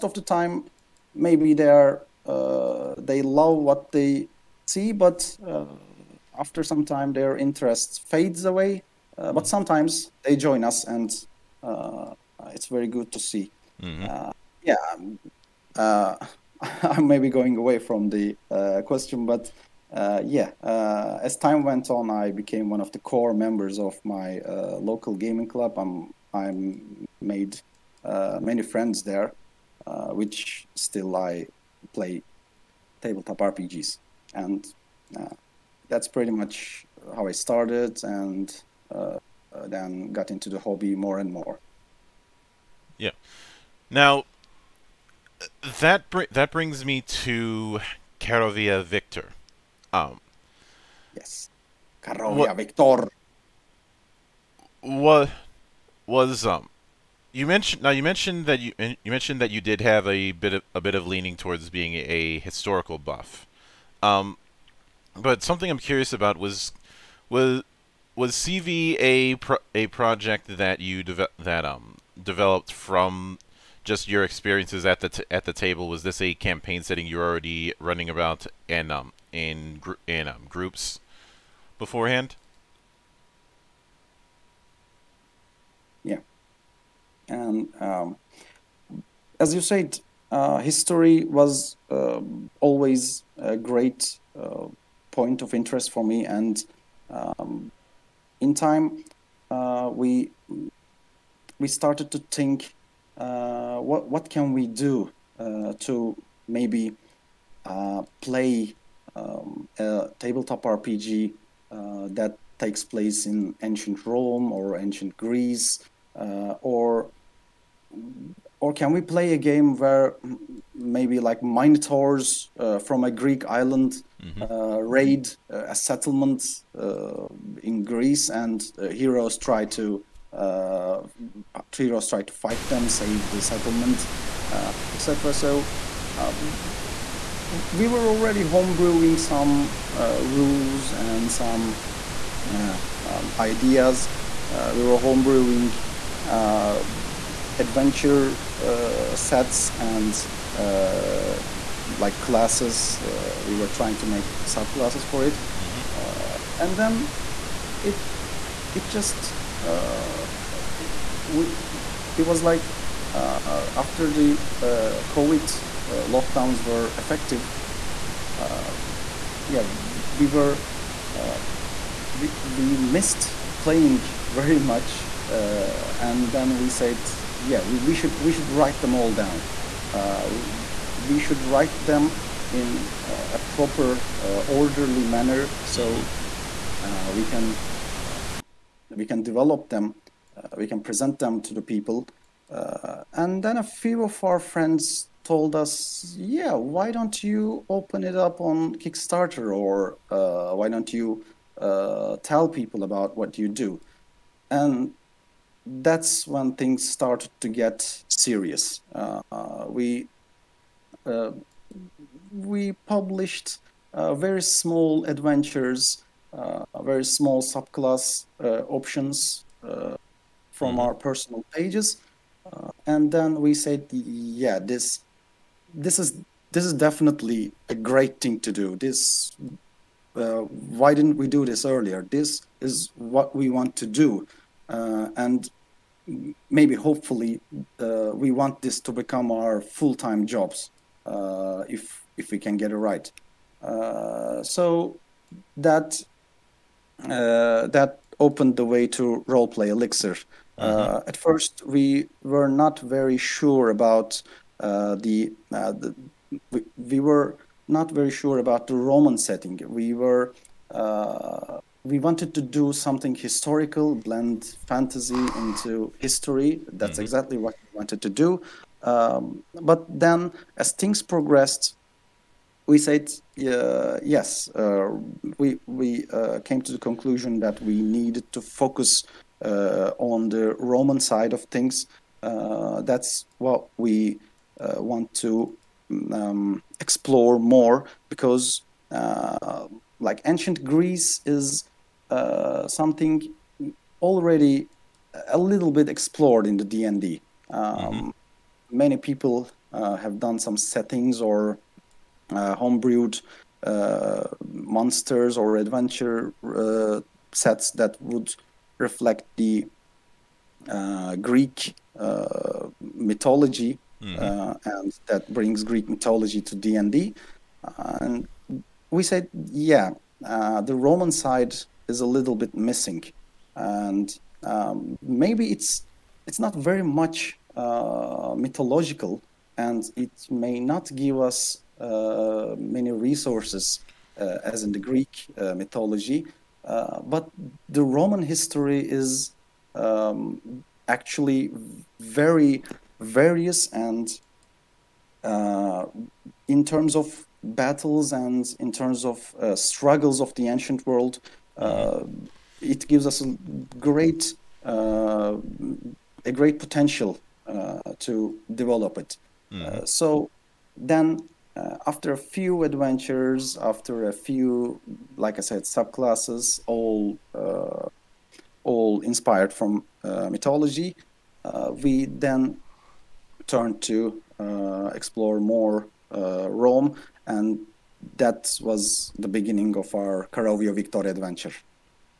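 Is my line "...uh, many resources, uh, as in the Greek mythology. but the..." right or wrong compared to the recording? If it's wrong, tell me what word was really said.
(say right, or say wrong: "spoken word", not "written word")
right.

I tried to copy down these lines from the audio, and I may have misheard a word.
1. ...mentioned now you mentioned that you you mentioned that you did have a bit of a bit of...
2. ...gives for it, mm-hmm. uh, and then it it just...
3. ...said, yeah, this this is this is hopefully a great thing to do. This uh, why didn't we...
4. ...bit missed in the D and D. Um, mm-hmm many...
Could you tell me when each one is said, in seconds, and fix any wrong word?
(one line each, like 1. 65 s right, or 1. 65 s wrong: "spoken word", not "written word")
1. 57 s right
2. 154 s wrong: "subclasses", not "gives"
3. 223 s wrong: "definitely", not "hopefully"
4. 295 s wrong: "explored", not "missed".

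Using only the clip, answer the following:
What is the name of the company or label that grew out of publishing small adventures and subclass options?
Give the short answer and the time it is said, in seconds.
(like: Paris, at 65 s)
Roleplay Elixir, at 249 s.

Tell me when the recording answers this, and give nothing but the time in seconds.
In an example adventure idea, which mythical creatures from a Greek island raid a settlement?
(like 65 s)
121 s.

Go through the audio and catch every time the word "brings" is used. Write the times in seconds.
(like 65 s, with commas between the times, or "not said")
46 s, 315 s.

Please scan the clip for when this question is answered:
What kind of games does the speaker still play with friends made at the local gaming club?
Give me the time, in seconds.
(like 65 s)
33 s.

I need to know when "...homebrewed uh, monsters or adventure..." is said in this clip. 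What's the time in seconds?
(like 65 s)
302 s.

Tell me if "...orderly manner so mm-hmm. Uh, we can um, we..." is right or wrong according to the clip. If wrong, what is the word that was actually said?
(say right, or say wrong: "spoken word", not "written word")
right.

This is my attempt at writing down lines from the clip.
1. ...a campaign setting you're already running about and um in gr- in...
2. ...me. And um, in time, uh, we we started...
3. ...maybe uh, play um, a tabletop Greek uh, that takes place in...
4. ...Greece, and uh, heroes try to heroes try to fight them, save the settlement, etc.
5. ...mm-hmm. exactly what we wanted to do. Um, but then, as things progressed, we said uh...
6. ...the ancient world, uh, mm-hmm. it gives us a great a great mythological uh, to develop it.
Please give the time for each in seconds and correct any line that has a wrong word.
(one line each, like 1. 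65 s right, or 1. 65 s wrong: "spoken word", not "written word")
1. 76 s right
2. 96 s right
3. 106 s wrong: "RPG", not "Greek"
4. 127 s right
5. 266 s right
6. 350 s wrong: "potential", not "mythological".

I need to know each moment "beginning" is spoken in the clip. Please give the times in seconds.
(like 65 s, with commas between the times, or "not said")
379 s.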